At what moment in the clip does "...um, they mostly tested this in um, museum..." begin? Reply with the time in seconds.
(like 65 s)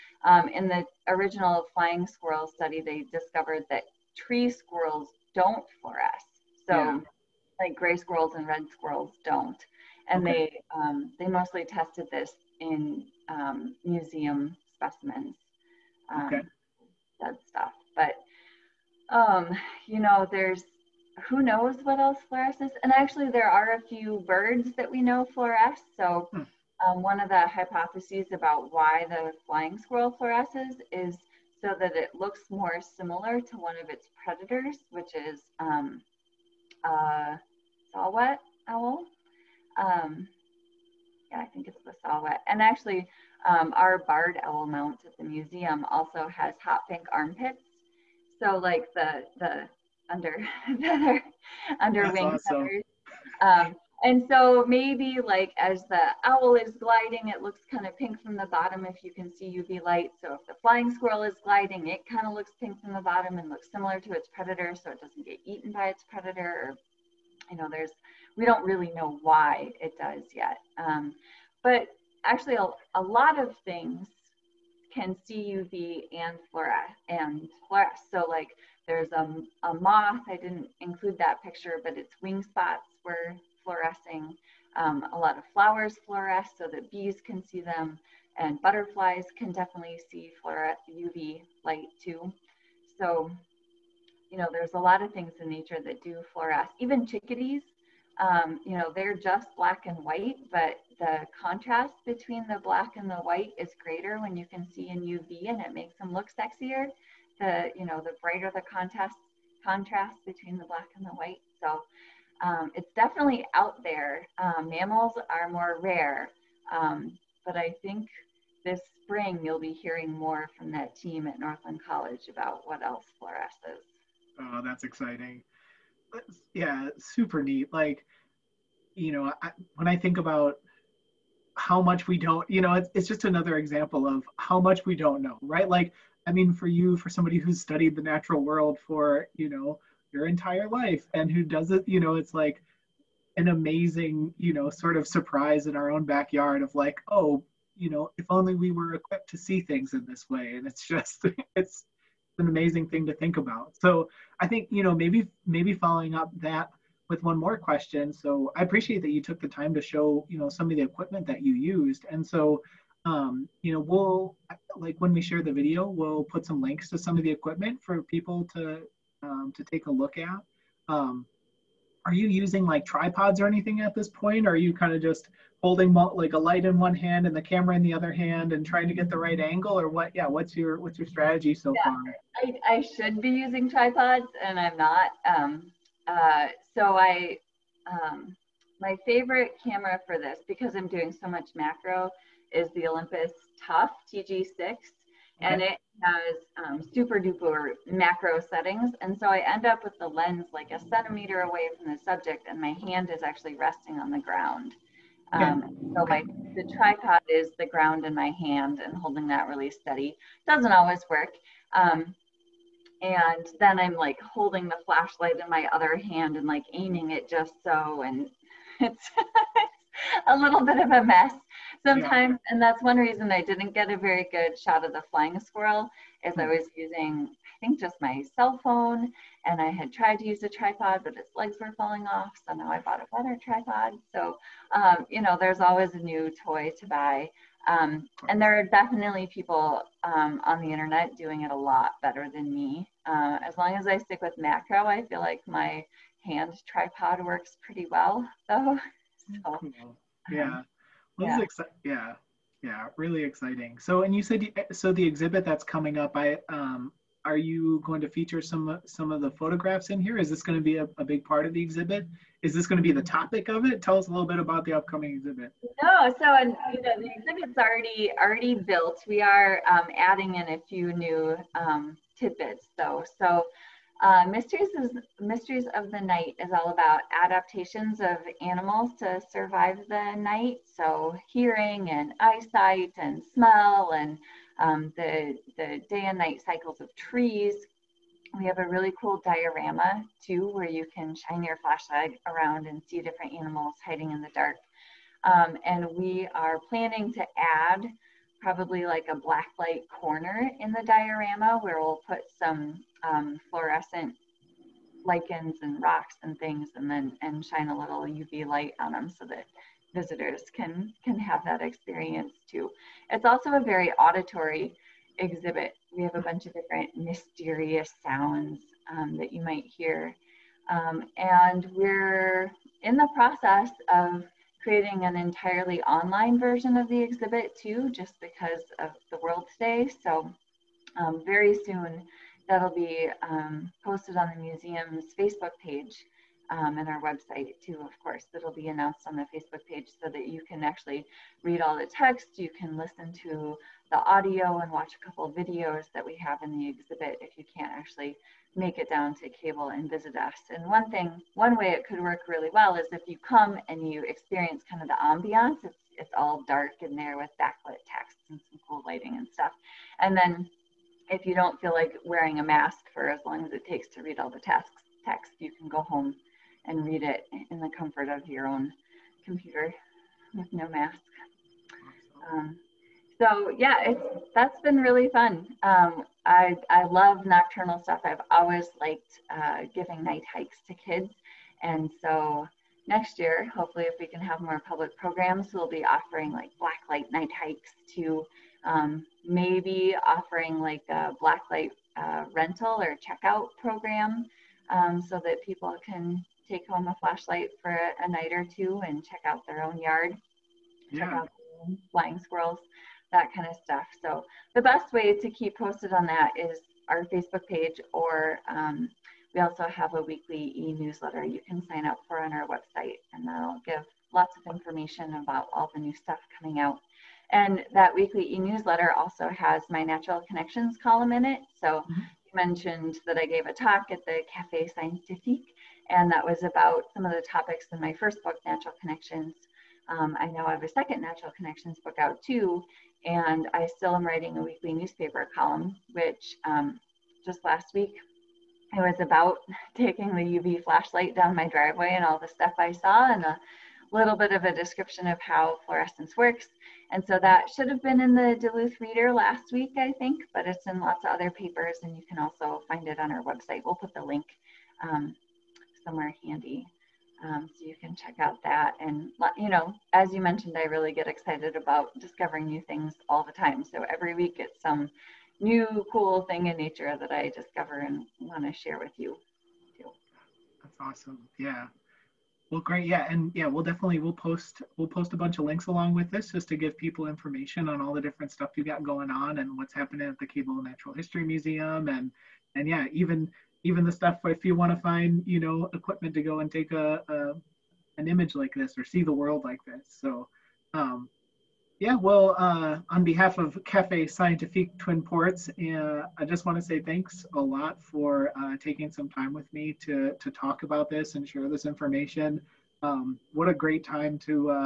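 10 s.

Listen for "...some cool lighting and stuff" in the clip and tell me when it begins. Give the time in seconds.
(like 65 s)
358 s.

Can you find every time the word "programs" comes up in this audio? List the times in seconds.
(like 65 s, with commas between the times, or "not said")
384 s, 393 s.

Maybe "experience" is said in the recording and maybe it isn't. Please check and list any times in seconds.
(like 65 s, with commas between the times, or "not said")
311 s, 354 s.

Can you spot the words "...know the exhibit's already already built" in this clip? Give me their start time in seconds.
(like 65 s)
266 s.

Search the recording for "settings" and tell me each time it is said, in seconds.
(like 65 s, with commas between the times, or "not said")
198 s.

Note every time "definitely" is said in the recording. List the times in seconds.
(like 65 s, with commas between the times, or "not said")
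89 s, 112 s, 238 s, 473 s.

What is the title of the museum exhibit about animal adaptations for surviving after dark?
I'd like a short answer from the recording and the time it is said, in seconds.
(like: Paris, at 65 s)
Mysteries of the Night, at 275 s.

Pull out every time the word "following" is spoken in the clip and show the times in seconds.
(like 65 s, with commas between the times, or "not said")
155 s.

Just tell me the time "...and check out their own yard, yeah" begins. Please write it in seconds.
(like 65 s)
398 s.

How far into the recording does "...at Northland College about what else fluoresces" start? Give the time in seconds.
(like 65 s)
121 s.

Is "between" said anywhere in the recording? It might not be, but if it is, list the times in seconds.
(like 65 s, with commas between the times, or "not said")
102 s, 110 s.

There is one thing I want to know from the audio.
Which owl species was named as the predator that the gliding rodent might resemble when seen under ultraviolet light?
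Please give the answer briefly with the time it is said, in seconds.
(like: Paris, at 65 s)
Saw-whet owl, at 37 s.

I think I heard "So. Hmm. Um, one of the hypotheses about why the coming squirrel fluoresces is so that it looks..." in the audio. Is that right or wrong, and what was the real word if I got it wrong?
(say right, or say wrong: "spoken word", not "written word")
wrong: "flying", not "coming".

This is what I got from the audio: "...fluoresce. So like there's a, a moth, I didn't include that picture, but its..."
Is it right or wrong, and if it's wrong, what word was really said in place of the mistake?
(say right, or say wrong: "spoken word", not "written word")
right.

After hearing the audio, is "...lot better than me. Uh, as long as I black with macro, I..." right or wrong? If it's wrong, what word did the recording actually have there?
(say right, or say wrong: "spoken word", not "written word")
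wrong: "stick", not "black".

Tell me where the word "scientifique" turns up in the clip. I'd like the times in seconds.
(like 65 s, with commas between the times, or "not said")
424 s, 494 s.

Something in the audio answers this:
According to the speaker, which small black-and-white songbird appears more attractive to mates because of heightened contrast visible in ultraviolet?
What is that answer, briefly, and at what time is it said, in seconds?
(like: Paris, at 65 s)
Chickadees, at 97 s.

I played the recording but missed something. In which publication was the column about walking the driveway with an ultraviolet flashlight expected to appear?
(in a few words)
Duluth Reader.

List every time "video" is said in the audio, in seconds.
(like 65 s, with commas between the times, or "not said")
165 s, 345 s.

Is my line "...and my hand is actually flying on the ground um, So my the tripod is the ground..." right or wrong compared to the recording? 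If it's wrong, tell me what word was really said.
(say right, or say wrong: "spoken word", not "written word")
wrong: "resting", not "flying".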